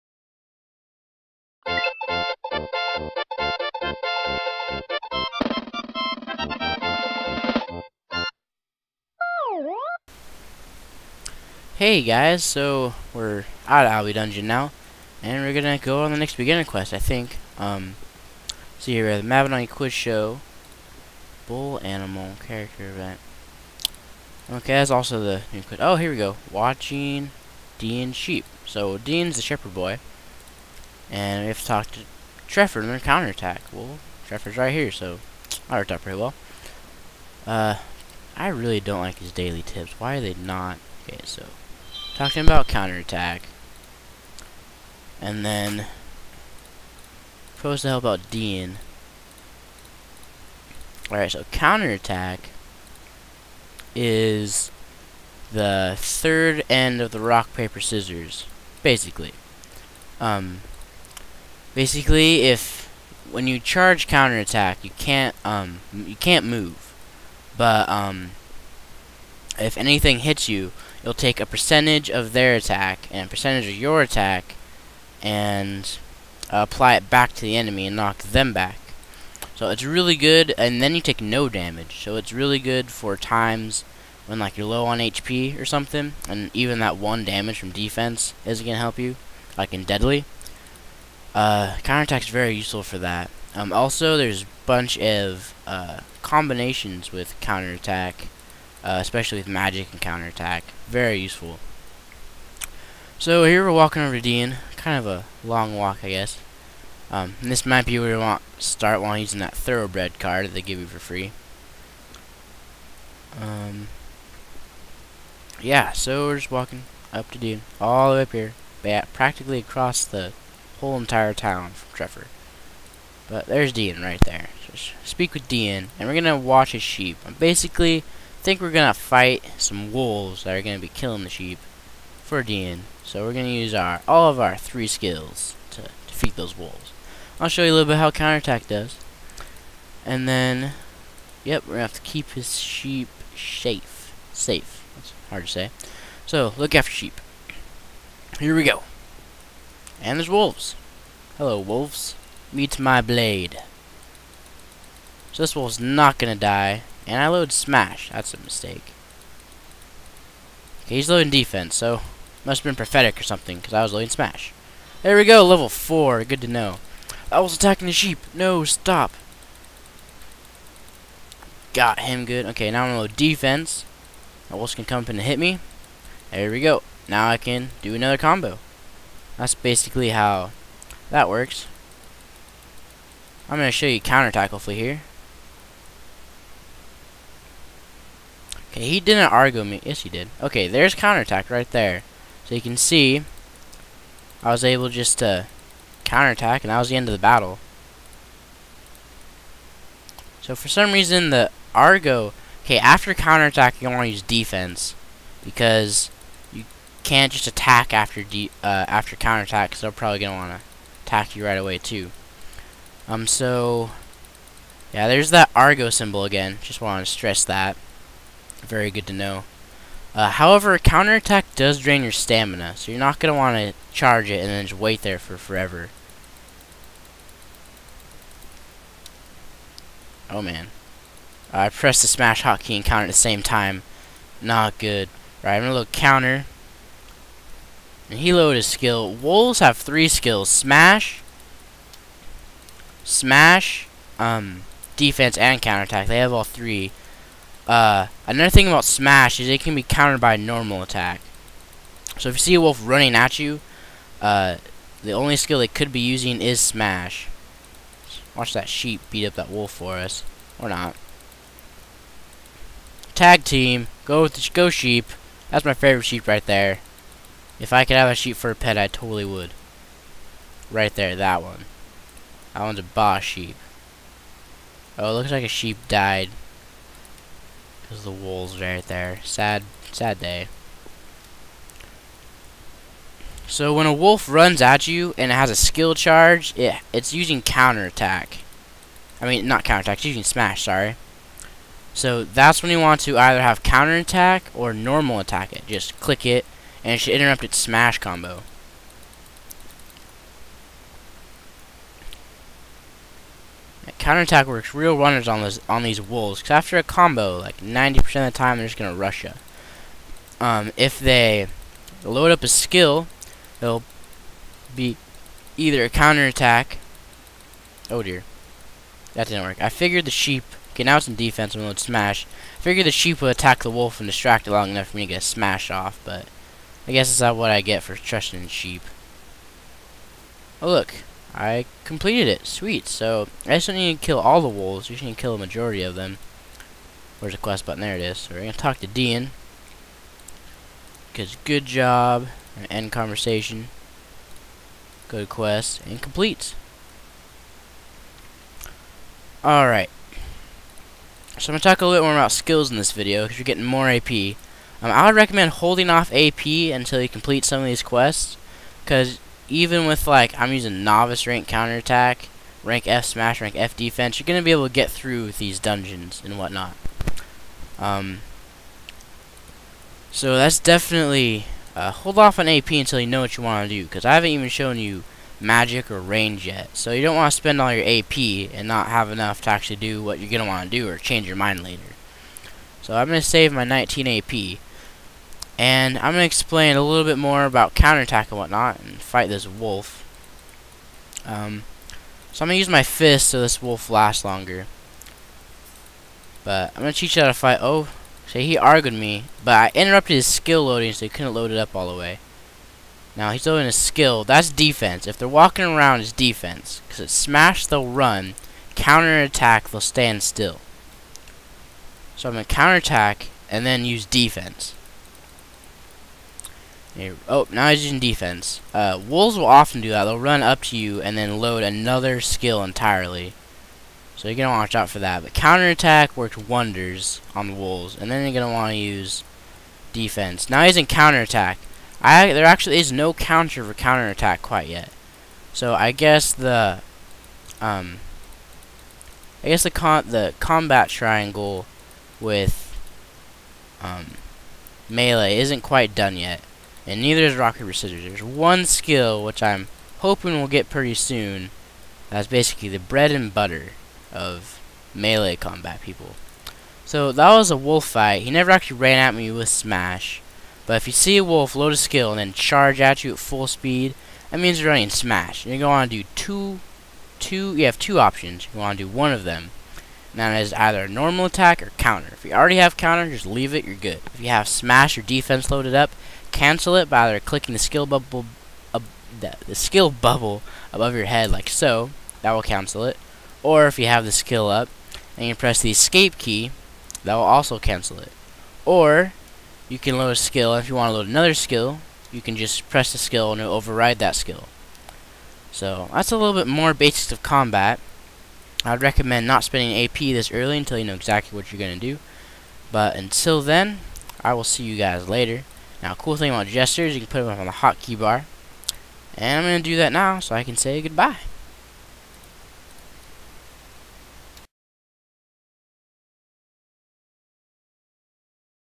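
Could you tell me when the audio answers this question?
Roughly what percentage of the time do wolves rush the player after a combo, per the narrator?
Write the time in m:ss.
5:07.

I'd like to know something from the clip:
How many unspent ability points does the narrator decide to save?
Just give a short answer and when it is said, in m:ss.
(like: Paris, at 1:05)
19 AP, at 6:23.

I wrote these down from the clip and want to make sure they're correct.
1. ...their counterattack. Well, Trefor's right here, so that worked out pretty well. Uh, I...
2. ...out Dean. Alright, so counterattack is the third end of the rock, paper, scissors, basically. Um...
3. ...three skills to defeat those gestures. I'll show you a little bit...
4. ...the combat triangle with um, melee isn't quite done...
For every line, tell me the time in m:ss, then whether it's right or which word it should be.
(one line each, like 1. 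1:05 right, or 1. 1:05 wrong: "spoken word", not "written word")
1. 0:32 right
2. 0:48 right
3. 2:14 wrong: "wolves", not "gestures"
4. 7:20 right.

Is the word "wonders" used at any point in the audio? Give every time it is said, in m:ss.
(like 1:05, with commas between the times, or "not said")
7:06.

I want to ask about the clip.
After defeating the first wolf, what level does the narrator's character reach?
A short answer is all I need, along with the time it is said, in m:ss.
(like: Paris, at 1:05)
4, at 2:45.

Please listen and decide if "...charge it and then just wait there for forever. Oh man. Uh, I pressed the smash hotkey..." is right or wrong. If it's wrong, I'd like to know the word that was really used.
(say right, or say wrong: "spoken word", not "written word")
right.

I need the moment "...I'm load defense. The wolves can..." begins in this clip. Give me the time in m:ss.
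2:52.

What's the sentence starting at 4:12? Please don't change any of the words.
So if you see a wolf running at you, uh, the only skill they could be using is Smash.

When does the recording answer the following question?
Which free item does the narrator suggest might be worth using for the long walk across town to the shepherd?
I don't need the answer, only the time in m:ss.
1:49.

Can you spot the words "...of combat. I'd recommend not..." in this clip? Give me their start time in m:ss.
8:17.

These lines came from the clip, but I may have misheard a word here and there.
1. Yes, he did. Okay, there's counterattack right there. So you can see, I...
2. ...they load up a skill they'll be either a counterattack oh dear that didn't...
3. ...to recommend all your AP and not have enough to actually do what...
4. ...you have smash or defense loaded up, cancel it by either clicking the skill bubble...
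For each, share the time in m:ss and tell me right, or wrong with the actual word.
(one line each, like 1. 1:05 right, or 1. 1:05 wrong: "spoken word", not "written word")
1. 3:09 right
2. 5:10 right
3. 6:17 wrong: "spend", not "recommend"
4. 7:54 right.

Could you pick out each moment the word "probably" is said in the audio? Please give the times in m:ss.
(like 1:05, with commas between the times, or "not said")
3:29.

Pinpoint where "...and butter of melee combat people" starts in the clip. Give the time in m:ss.
7:33.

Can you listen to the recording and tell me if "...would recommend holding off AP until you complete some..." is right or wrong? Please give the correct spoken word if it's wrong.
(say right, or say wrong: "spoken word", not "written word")
right.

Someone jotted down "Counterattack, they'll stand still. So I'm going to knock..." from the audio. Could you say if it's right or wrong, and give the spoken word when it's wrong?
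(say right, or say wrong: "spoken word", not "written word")
wrong: "counterattack", not "knock".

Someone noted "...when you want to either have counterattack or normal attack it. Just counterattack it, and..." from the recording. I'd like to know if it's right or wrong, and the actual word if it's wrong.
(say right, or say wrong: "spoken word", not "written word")
wrong: "click", not "counterattack".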